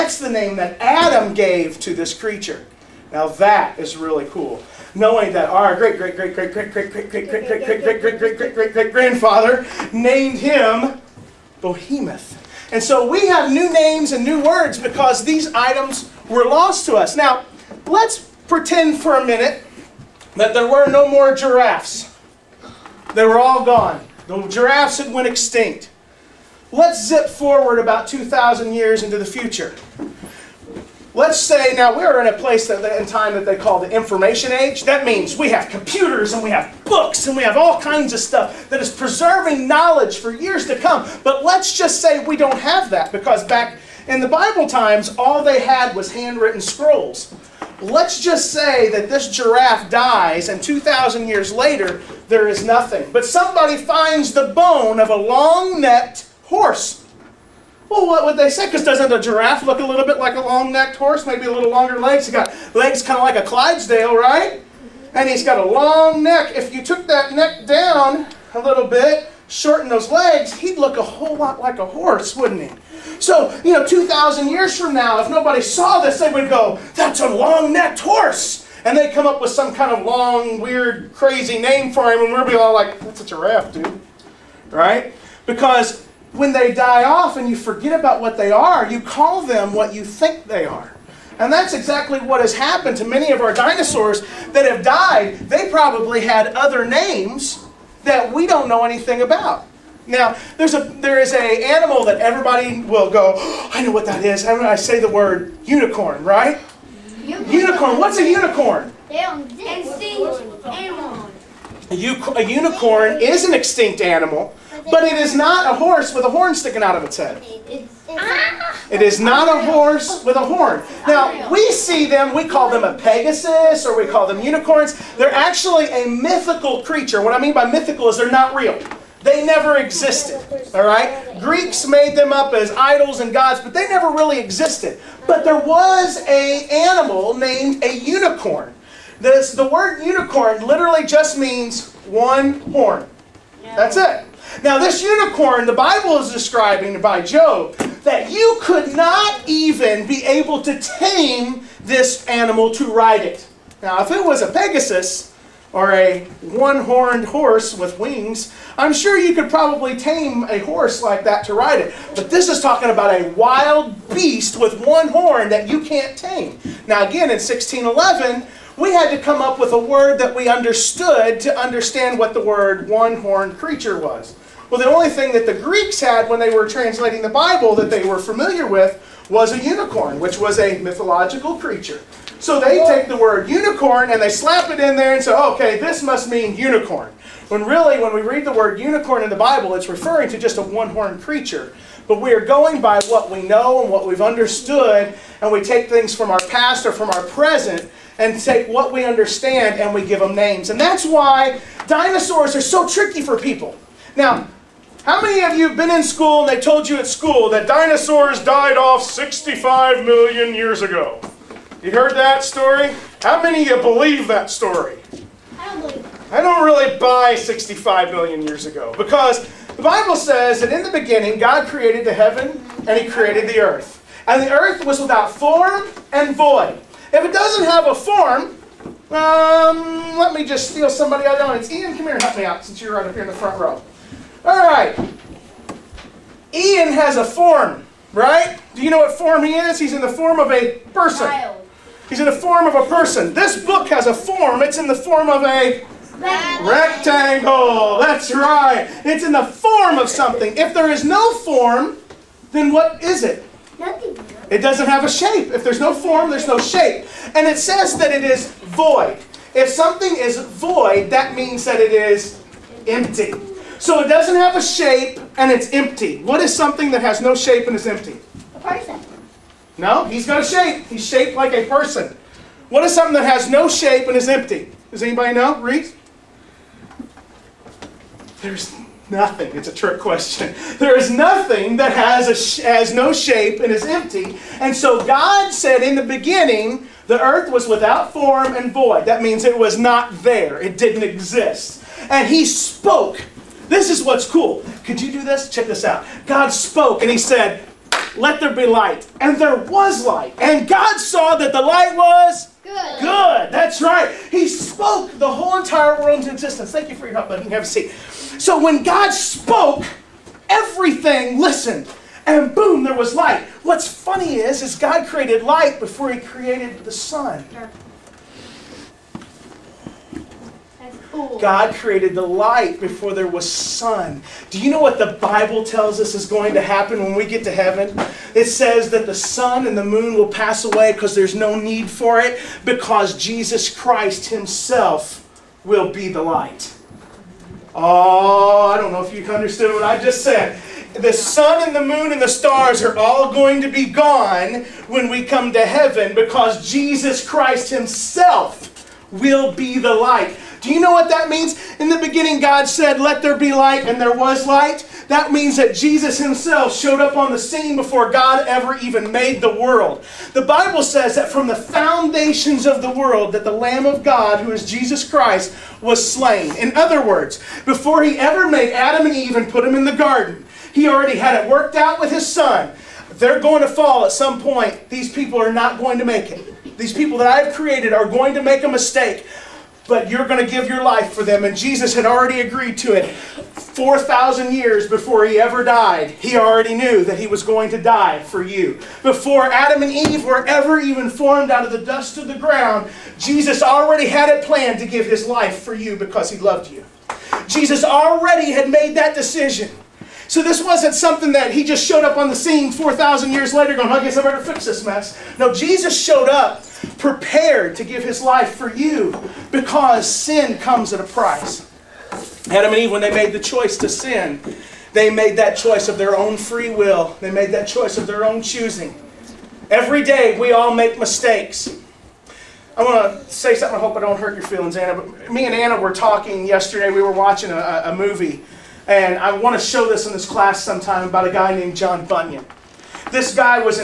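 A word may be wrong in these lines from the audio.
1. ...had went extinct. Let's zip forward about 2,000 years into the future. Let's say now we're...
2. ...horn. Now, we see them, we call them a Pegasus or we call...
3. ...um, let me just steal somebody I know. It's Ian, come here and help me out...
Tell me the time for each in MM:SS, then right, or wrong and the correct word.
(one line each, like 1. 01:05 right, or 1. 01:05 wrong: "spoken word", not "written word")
1. 00:24 right
2. 02:00 right
3. 03:49 right.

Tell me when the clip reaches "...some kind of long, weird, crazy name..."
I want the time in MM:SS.
01:19.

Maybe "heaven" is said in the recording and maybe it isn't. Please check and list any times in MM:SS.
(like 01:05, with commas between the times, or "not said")
03:42, 05:27, 05:45.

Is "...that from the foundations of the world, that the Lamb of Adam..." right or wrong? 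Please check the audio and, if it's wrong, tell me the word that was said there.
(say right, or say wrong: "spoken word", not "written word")
wrong: "God", not "Adam".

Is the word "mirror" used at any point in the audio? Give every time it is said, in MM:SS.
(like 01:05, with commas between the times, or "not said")
not said.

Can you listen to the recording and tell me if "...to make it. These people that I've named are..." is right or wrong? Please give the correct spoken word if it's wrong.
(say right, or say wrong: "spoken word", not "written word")
wrong: "created", not "named".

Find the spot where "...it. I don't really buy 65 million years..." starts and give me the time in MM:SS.
03:35.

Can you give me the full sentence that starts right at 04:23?
So it doesn't have a shape and it's empty.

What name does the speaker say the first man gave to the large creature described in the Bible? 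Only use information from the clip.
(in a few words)
Bohemoth.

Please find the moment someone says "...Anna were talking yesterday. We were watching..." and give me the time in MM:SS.
07:05.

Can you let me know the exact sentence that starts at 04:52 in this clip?
And He spoke, this is what's cool.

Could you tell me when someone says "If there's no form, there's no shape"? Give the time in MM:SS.
04:15.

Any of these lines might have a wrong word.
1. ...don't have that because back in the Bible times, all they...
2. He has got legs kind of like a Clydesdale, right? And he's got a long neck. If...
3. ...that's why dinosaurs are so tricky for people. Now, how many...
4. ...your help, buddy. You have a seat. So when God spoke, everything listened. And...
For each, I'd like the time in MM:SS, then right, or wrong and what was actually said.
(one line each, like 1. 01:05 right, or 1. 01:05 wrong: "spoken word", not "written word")
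1. 00:42 right
2. 01:02 right
3. 03:20 right
4. 05:07 right.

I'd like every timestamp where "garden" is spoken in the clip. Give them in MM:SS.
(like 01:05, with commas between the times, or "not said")
06:09.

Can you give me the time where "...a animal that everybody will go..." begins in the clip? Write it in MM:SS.
01:41.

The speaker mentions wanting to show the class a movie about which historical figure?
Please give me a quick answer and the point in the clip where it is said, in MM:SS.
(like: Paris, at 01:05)
John Bunyan, at 07:11.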